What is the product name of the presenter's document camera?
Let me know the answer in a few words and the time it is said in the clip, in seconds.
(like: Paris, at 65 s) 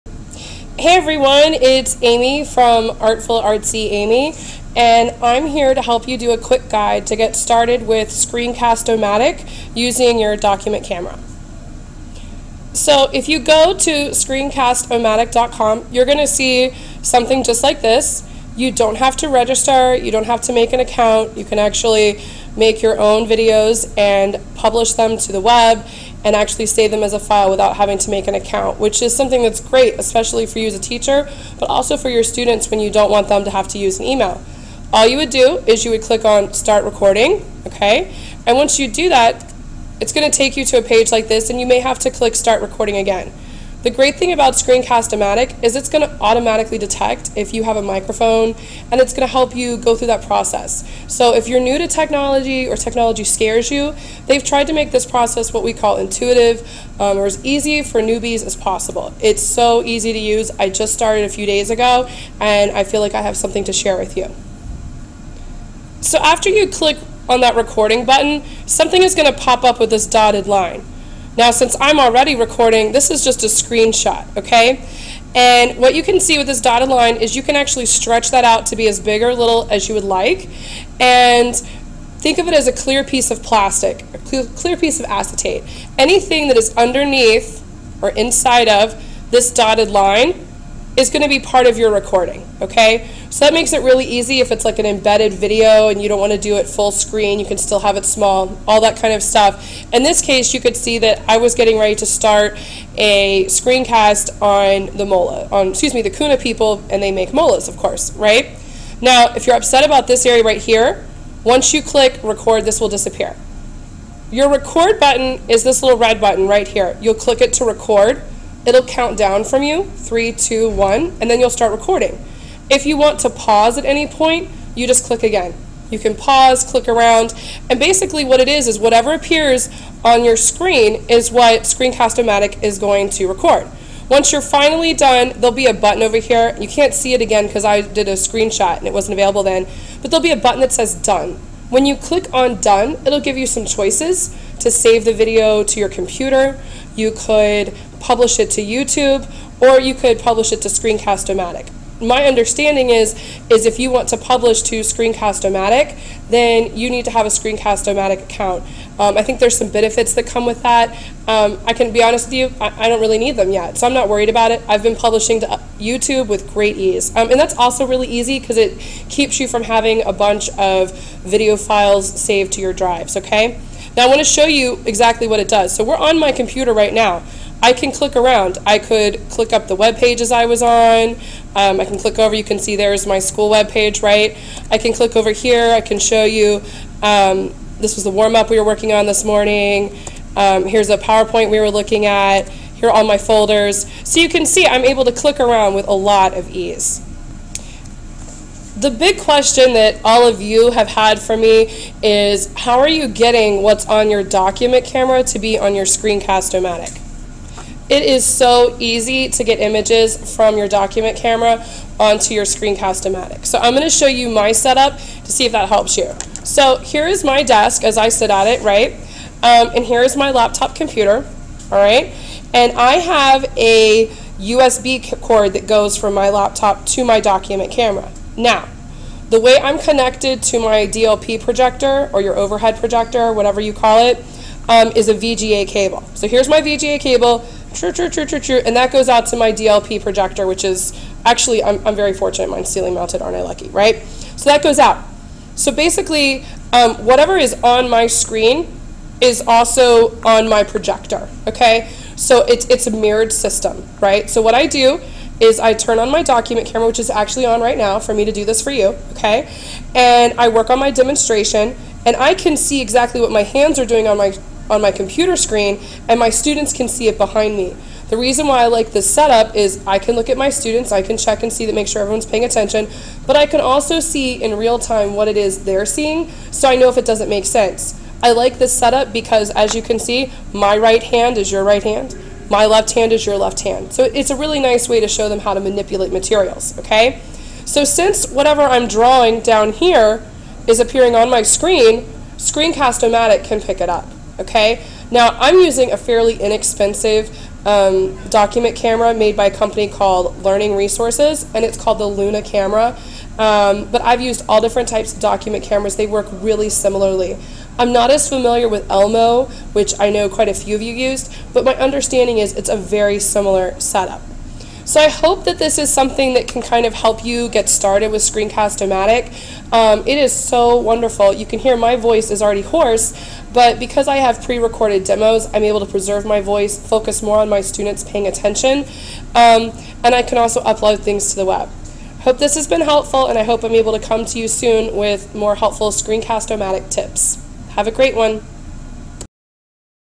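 Luna, at 302 s.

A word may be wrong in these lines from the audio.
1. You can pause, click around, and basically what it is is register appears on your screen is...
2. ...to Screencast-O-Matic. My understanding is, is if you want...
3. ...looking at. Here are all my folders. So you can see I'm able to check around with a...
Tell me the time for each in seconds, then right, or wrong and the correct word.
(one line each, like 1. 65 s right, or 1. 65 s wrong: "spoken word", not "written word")
1. 125 s wrong: "whatever", not "register"
2. 150 s right
3. 191 s wrong: "click", not "check".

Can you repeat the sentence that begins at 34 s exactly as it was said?
All you would do is you would click on start recording, okay?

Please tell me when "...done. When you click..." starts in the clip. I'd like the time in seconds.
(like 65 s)
140 s.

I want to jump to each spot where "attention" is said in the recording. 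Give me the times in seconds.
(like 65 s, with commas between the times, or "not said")
272 s, 328 s.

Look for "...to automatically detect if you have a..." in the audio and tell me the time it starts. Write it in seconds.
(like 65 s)
46 s.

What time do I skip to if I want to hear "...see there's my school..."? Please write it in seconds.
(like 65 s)
182 s.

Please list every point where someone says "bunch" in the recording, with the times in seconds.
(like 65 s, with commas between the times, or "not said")
170 s.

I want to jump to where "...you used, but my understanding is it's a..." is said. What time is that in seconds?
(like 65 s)
310 s.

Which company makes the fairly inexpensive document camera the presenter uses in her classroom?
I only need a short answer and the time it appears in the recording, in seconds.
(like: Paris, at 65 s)
Learning Resources, at 300 s.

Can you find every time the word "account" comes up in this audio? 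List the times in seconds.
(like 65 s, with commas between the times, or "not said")
20 s, 28 s, 158 s.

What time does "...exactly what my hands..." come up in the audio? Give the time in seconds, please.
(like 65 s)
262 s.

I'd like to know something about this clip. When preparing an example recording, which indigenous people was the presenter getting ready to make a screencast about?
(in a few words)
Kuna.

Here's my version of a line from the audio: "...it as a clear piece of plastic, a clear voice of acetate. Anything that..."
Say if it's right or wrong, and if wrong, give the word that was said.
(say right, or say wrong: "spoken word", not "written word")
wrong: "piece", not "voice".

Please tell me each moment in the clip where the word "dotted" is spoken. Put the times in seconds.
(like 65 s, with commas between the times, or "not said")
70 s, 76 s, 89 s.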